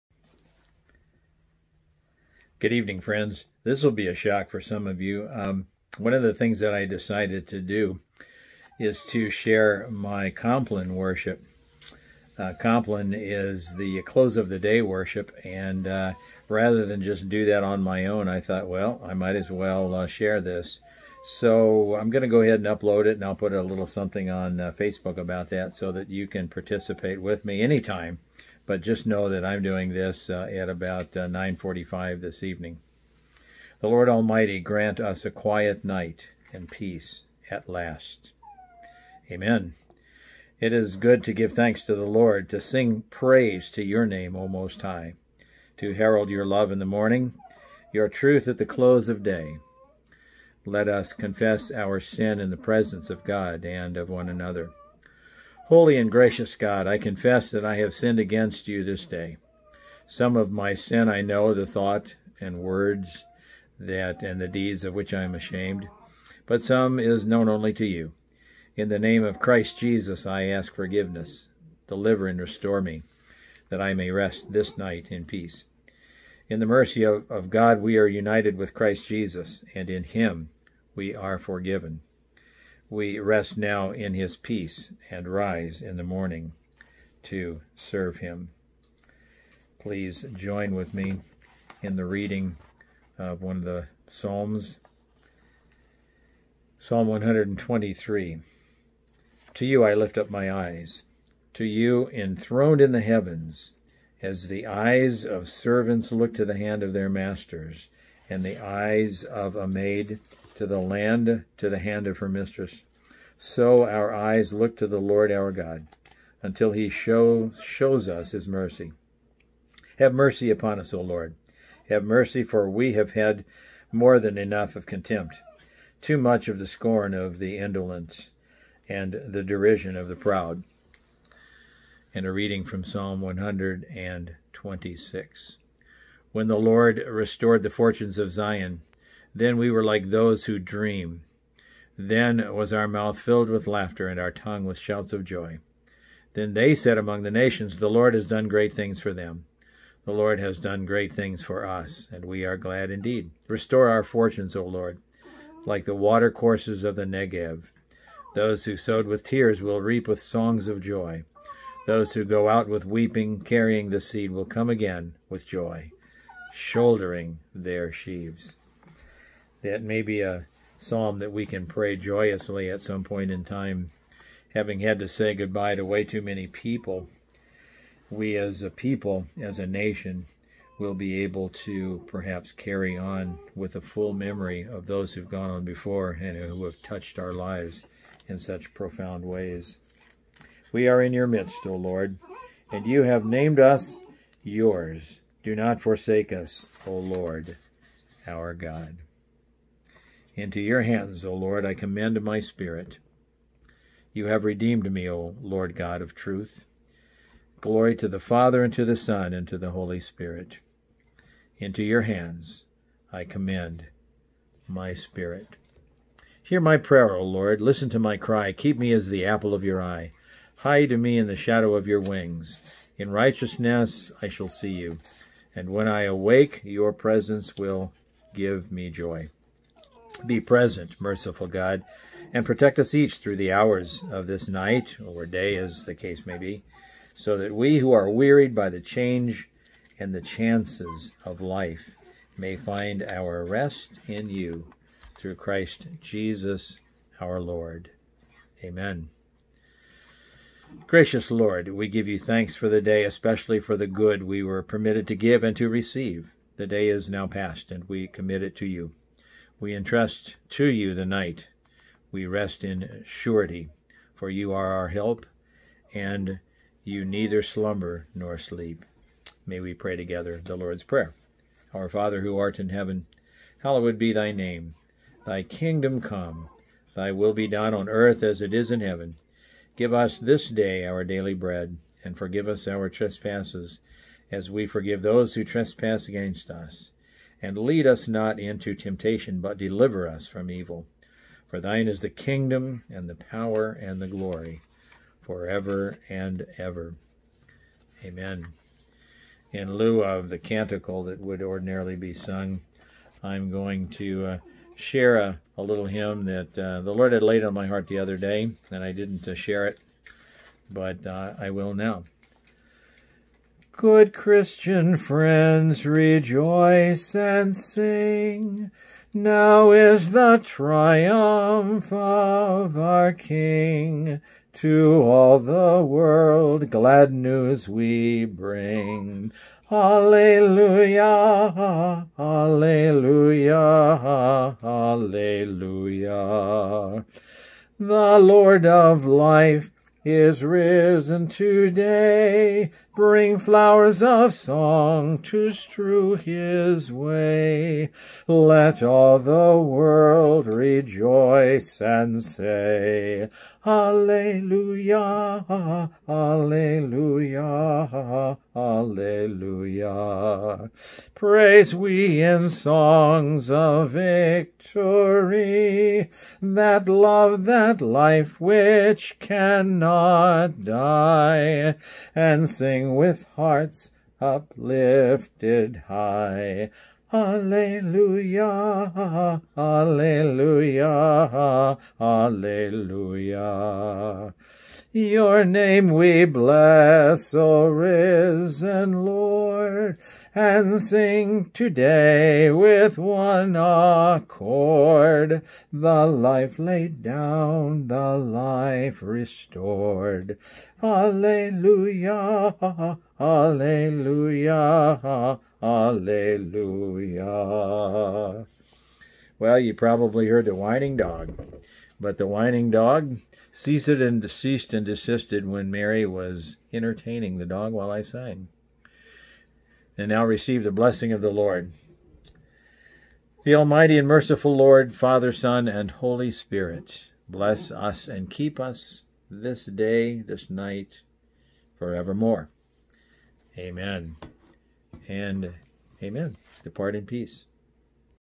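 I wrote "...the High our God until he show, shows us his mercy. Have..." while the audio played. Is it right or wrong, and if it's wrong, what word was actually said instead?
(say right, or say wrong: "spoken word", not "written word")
wrong: "Lord", not "High".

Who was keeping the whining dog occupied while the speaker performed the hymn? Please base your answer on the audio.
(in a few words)
Mary.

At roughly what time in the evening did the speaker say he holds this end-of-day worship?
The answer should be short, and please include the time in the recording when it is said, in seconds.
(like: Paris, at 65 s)
9:45, at 31 s.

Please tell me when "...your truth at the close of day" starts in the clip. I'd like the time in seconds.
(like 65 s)
47 s.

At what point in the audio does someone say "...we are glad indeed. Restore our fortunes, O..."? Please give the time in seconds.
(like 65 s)
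152 s.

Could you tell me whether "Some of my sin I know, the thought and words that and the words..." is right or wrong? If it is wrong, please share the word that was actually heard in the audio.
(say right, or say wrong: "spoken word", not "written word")
wrong: "deeds", not "words".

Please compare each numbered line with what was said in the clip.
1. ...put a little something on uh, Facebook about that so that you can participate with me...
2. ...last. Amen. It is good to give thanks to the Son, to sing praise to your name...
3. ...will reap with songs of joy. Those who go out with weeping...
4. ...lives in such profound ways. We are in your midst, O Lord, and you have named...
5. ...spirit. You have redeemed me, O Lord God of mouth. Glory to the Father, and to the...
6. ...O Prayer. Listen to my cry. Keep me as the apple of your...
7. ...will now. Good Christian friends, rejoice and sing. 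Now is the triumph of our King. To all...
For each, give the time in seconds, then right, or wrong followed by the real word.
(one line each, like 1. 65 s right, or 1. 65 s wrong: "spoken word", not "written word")
1. 23 s right
2. 37 s wrong: "Lord", not "Son"
3. 159 s right
4. 187 s right
5. 202 s wrong: "truth", not "mouth"
6. 217 s wrong: "Lord", not "Prayer"
7. 311 s right.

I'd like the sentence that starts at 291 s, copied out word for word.
For thine is the kingdom, and the power, and the glory, forever and ever.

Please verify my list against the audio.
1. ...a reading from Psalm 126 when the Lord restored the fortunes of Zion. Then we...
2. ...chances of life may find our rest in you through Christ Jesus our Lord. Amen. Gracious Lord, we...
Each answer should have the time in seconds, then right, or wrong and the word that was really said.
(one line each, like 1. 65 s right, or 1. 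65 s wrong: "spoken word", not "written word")
1. 132 s right
2. 240 s right.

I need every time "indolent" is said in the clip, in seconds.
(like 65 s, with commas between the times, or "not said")
127 s.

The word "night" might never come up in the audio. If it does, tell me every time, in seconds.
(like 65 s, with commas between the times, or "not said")
35 s, 74 s, 234 s, 261 s, 430 s.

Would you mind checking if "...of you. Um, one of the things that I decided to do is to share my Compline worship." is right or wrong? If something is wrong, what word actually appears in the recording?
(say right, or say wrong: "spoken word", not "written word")
right.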